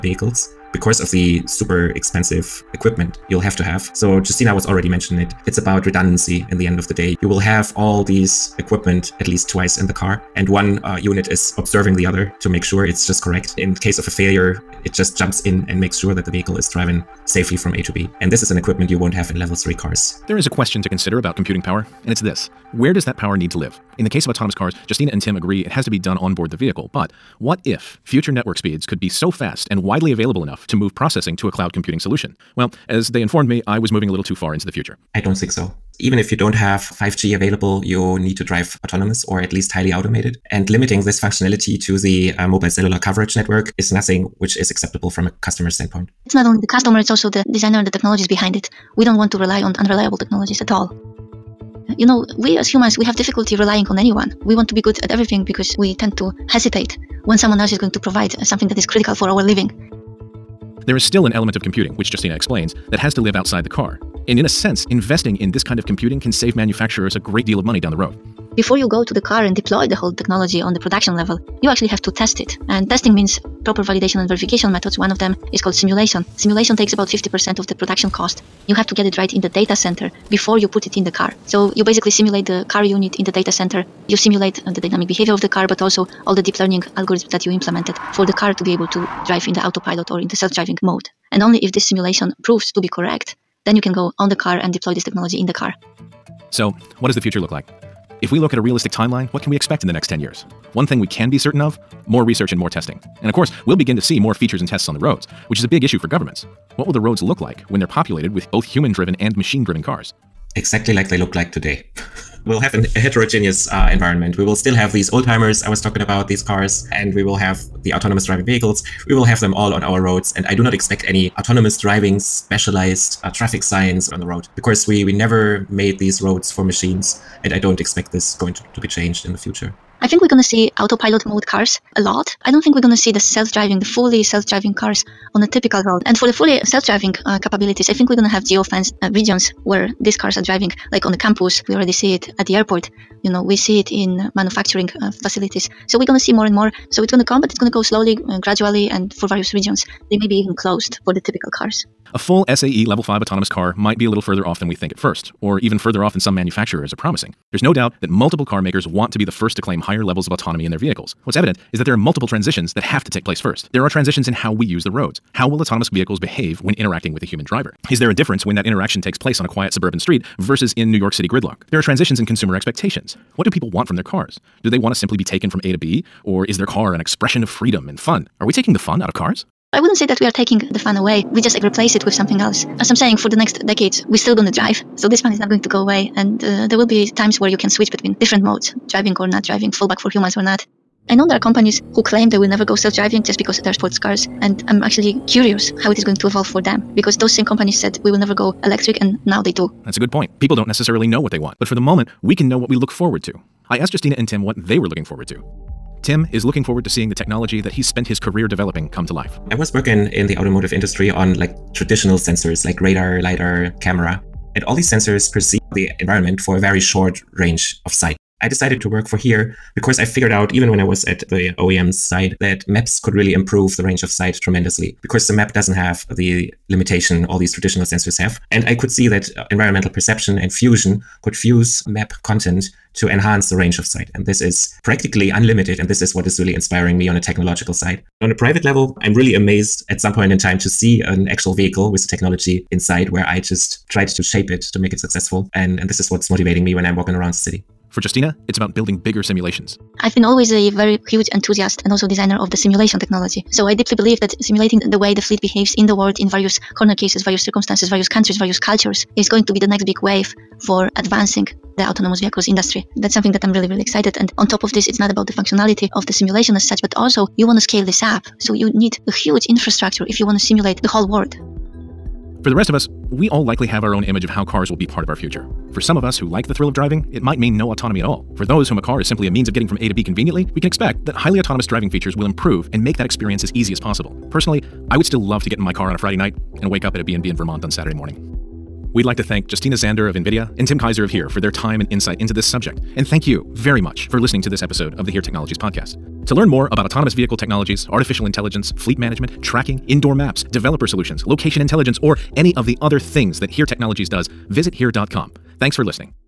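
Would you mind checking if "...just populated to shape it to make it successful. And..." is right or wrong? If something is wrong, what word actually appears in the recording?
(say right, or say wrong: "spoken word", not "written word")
wrong: "tried", not "populated".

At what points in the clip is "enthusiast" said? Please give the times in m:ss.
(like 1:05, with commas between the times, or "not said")
4:11.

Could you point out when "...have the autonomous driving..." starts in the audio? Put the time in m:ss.
1:57.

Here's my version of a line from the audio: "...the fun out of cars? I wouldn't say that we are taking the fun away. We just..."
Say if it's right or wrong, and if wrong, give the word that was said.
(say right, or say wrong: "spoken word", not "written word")
right.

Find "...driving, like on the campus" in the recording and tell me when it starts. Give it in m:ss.
2:20.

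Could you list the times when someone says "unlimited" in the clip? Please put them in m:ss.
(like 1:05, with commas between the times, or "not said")
3:55.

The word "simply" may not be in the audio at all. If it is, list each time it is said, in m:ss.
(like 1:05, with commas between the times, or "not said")
2:54, 4:39.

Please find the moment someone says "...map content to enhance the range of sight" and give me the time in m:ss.
3:51.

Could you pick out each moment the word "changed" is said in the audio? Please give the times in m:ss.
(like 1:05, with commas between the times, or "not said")
2:08.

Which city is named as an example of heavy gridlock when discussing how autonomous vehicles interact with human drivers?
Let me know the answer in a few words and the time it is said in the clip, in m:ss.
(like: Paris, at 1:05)
New York City, at 2:50.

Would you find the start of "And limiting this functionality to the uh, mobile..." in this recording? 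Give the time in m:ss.
0:40.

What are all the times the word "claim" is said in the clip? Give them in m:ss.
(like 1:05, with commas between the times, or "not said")
2:39, 3:12.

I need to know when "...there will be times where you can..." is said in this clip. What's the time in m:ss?
3:06.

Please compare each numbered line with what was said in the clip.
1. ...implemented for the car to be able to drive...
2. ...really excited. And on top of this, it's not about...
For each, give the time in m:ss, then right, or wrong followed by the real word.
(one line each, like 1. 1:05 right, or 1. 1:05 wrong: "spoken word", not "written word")
1. 1:27 right
2. 4:23 right.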